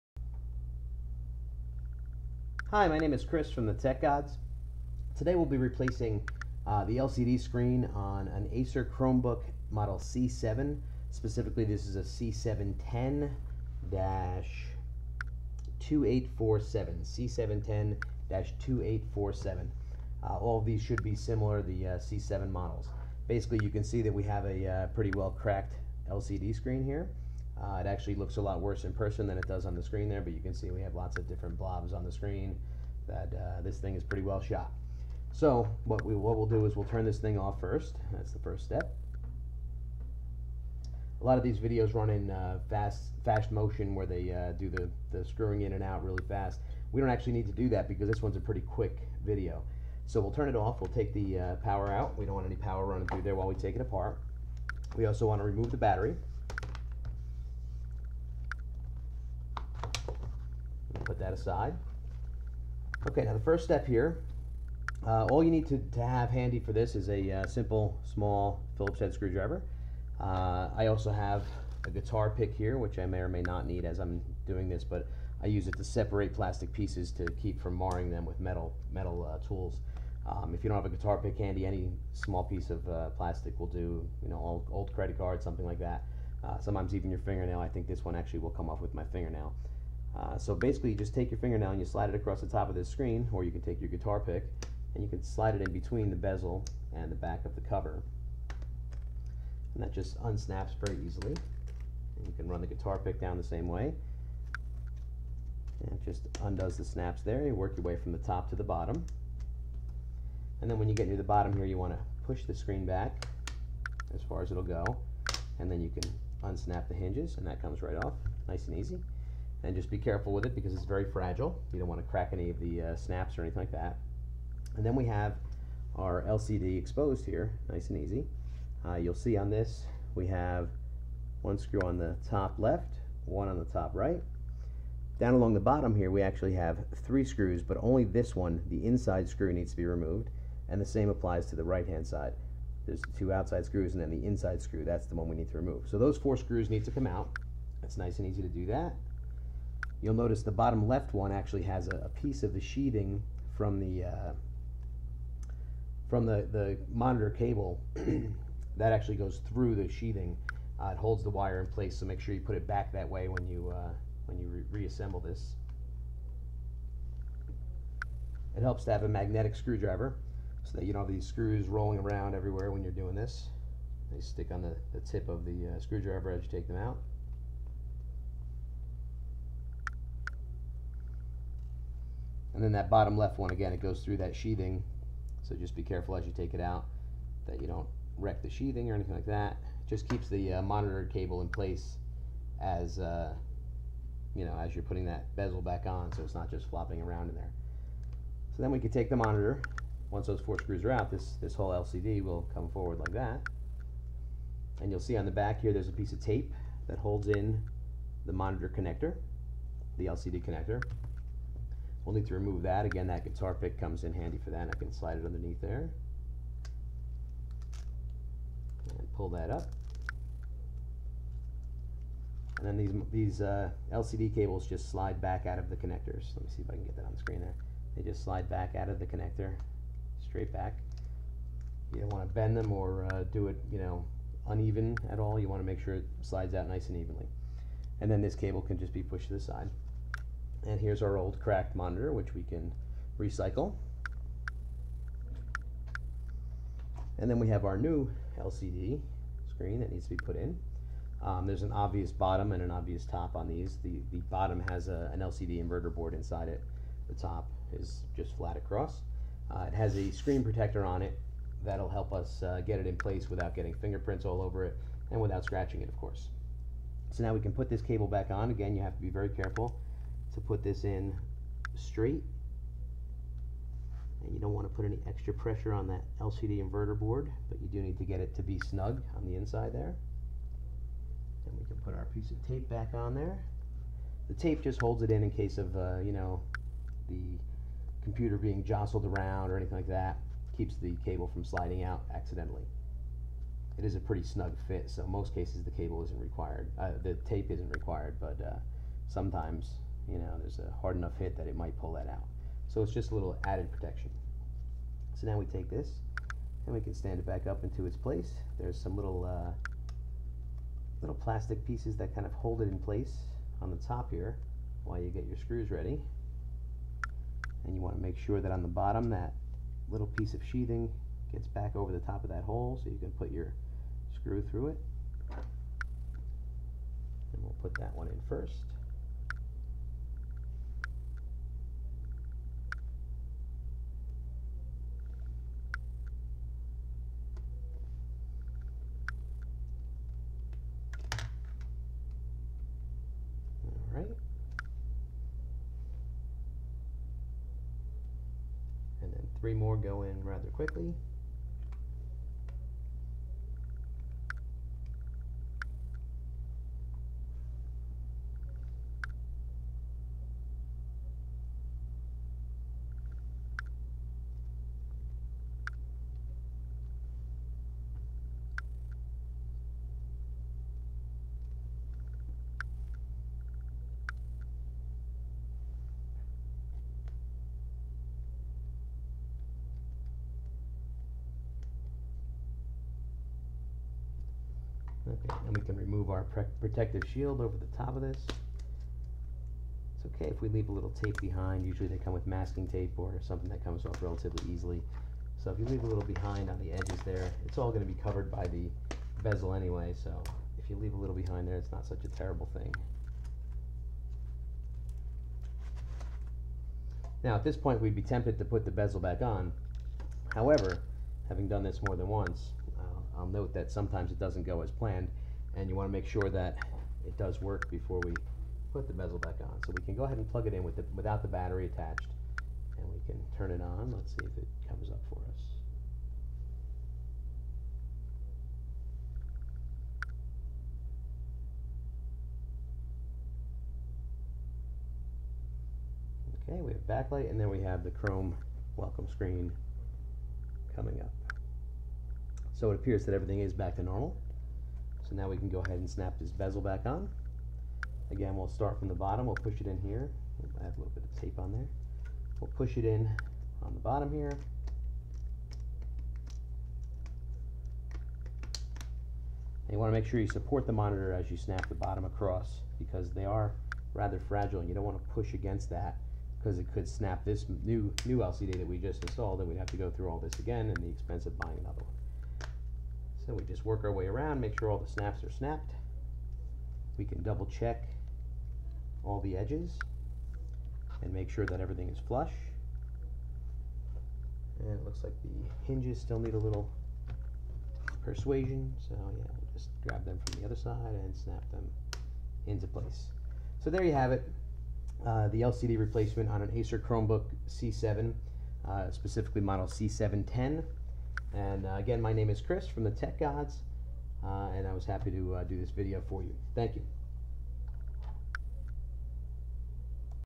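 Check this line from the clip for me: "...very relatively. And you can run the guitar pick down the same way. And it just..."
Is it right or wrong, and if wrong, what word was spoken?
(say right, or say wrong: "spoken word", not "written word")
wrong: "easily", not "relatively".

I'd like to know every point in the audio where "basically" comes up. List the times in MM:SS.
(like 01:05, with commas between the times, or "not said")
00:23, 01:30.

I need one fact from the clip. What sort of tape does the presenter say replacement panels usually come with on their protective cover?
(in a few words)
masking tape.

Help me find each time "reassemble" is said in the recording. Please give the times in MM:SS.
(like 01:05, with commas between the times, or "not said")
02:44.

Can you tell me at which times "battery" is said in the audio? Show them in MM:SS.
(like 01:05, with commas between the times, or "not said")
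00:55, 07:01.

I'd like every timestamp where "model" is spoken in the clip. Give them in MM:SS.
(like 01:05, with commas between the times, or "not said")
00:09, 00:22, 08:19.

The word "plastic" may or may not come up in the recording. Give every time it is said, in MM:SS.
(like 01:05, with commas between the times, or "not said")
01:16, 01:23, 05:11.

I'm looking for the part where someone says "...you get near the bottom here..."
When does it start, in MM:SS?
01:50.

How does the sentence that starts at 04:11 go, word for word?
Um, there's an obvious bottom and an obvious top on these.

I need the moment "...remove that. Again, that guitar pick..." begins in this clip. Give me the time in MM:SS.
03:32.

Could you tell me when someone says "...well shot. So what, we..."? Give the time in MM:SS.
00:34.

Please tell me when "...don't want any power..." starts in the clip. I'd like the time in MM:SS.
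00:52.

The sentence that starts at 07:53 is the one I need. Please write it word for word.
So we just work our way around, make sure all the snaps are snapped.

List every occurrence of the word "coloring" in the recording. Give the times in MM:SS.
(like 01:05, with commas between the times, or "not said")
not said.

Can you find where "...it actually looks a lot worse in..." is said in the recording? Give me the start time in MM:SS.
00:27.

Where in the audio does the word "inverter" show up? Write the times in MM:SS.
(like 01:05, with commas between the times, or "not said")
04:15, 04:36.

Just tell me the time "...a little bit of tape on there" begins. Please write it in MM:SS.
07:30.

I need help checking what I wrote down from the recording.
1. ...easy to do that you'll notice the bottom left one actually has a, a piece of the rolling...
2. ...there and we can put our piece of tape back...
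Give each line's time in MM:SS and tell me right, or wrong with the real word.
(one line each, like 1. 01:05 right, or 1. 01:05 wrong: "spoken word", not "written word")
1. 02:28 wrong: "sheathing", not "rolling"
2. 04:39 right.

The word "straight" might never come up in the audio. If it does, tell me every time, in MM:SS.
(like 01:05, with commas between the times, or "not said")
03:50, 04:31.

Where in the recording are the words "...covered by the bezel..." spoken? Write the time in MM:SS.
06:38.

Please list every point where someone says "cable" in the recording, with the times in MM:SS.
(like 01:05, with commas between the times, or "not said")
02:37, 03:11, 03:44, 03:58, 04:27, 04:51, 04:55.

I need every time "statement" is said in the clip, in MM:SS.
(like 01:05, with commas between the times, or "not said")
not said.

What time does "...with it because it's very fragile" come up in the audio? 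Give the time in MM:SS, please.
02:00.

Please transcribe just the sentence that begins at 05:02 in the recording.
So it's just a little added protection.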